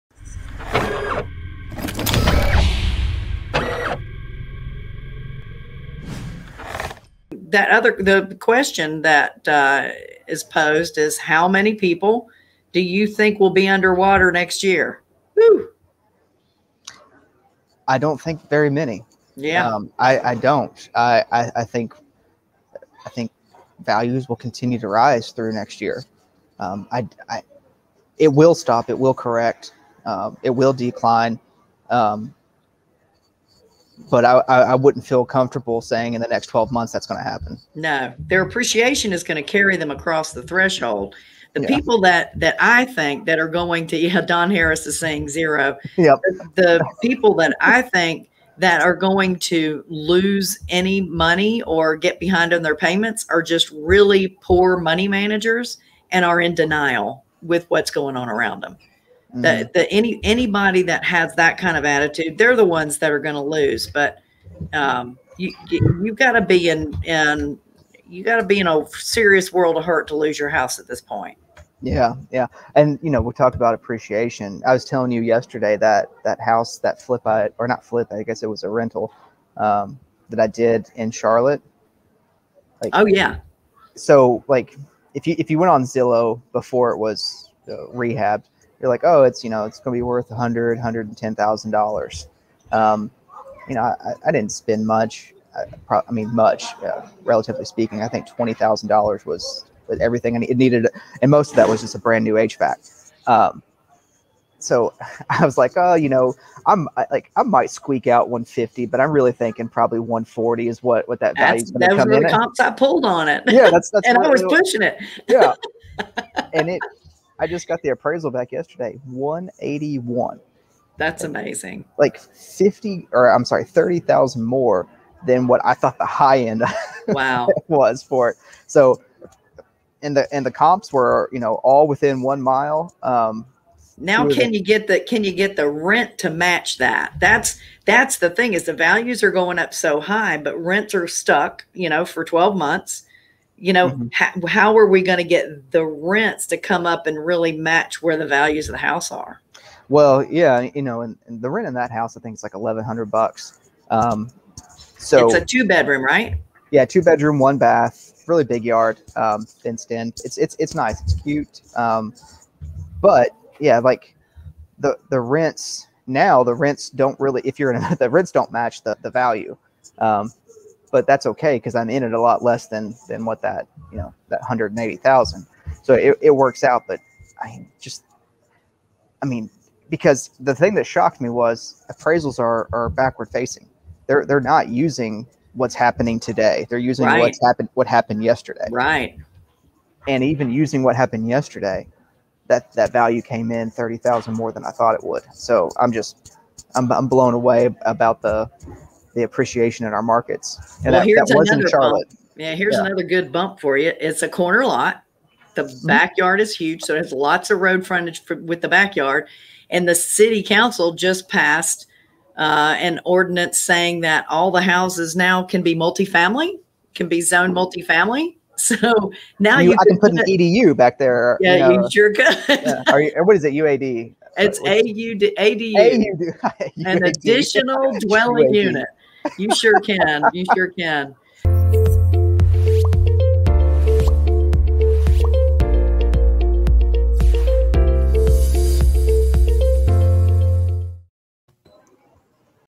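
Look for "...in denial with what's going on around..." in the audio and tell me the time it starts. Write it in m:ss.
0:56.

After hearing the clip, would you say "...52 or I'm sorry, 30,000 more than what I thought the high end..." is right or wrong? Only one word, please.
wrong.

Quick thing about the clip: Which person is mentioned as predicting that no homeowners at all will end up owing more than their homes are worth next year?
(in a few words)
Don Harris.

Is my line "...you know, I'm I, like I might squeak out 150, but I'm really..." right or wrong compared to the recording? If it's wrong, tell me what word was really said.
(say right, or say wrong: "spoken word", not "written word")
right.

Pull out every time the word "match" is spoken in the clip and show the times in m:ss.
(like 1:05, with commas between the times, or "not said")
2:16, 2:27, 2:48.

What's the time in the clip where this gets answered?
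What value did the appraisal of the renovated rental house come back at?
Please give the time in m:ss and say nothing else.
1:59.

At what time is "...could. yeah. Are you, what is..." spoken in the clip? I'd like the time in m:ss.
3:42.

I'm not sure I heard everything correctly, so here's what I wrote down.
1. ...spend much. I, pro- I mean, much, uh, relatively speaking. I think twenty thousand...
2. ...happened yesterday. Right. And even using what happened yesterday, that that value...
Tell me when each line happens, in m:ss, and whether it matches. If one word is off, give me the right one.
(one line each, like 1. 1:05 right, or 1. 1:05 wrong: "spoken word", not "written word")
1. 1:34 right
2. 3:07 right.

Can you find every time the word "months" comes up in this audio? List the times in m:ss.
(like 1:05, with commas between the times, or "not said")
0:36, 2:22.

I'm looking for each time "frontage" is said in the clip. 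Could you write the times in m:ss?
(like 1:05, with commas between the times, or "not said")
3:27.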